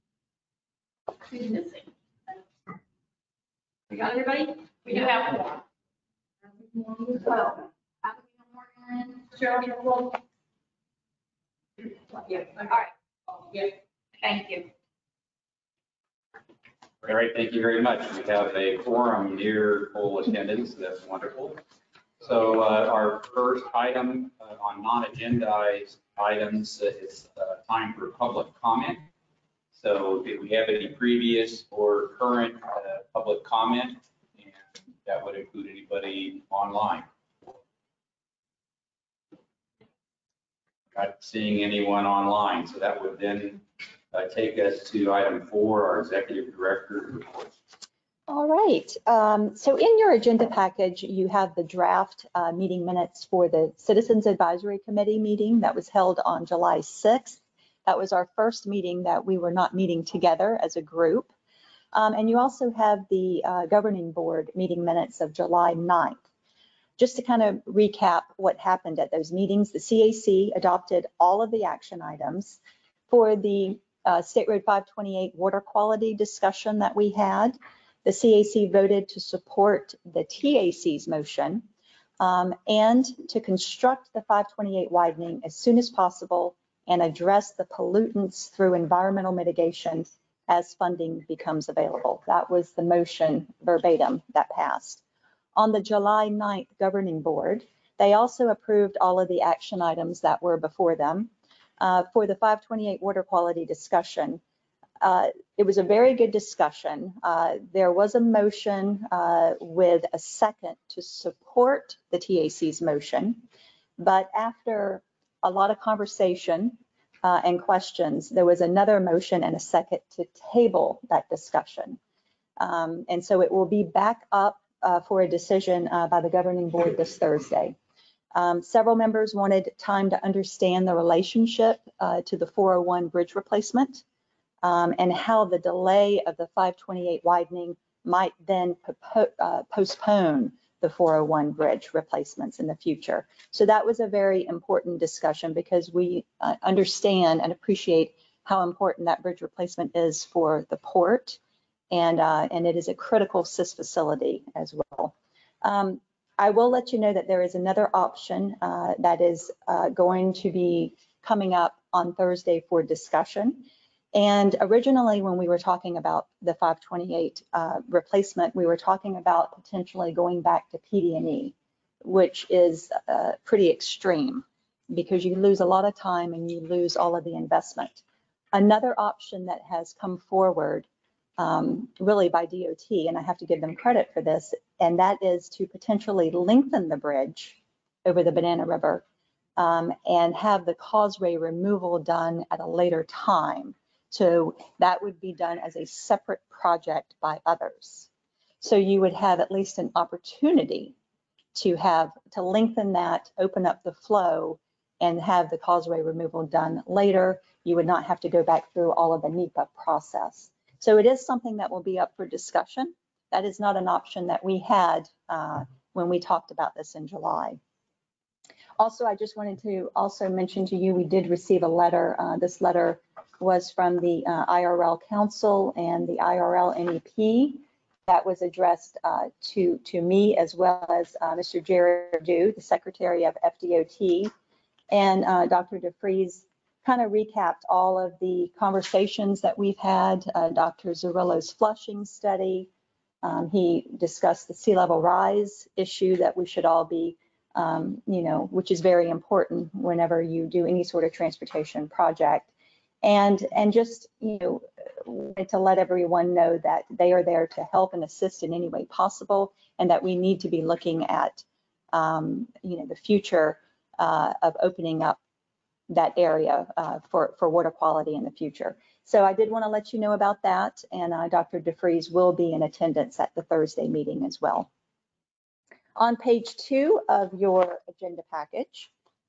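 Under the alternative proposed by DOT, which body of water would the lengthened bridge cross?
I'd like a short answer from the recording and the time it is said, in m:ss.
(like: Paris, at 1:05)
Banana River, at 3:08.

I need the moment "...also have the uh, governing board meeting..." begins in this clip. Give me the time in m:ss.
1:02.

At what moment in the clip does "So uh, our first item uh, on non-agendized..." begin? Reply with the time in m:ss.
0:22.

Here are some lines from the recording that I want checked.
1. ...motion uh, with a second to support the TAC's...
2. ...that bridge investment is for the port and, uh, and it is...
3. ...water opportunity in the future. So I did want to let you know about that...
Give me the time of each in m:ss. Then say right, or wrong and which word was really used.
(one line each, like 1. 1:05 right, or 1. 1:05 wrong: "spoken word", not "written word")
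1. 1:48 right
2. 2:29 wrong: "replacement", not "investment"
3. 4:27 wrong: "quality", not "opportunity".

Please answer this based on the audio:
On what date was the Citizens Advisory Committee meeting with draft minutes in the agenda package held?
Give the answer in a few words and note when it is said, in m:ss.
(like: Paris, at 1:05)
July 6th, at 0:56.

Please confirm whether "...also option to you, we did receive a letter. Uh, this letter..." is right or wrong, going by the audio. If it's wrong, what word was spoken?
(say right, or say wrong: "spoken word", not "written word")
wrong: "mention", not "option".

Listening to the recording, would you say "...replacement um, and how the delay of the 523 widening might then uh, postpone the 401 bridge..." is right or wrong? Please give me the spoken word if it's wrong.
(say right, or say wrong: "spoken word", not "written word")
wrong: "528", not "523".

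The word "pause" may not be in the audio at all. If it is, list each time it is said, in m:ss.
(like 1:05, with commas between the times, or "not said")
not said.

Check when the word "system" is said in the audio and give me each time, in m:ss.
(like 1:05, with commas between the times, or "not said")
not said.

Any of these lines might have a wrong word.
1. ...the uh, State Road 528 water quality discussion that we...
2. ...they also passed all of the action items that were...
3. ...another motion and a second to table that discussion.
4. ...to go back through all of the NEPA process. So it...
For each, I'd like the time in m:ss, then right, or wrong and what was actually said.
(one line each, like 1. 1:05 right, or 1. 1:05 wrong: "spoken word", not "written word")
1. 1:13 right
2. 1:37 wrong: "approved", not "passed"
3. 1:58 right
4. 3:28 right.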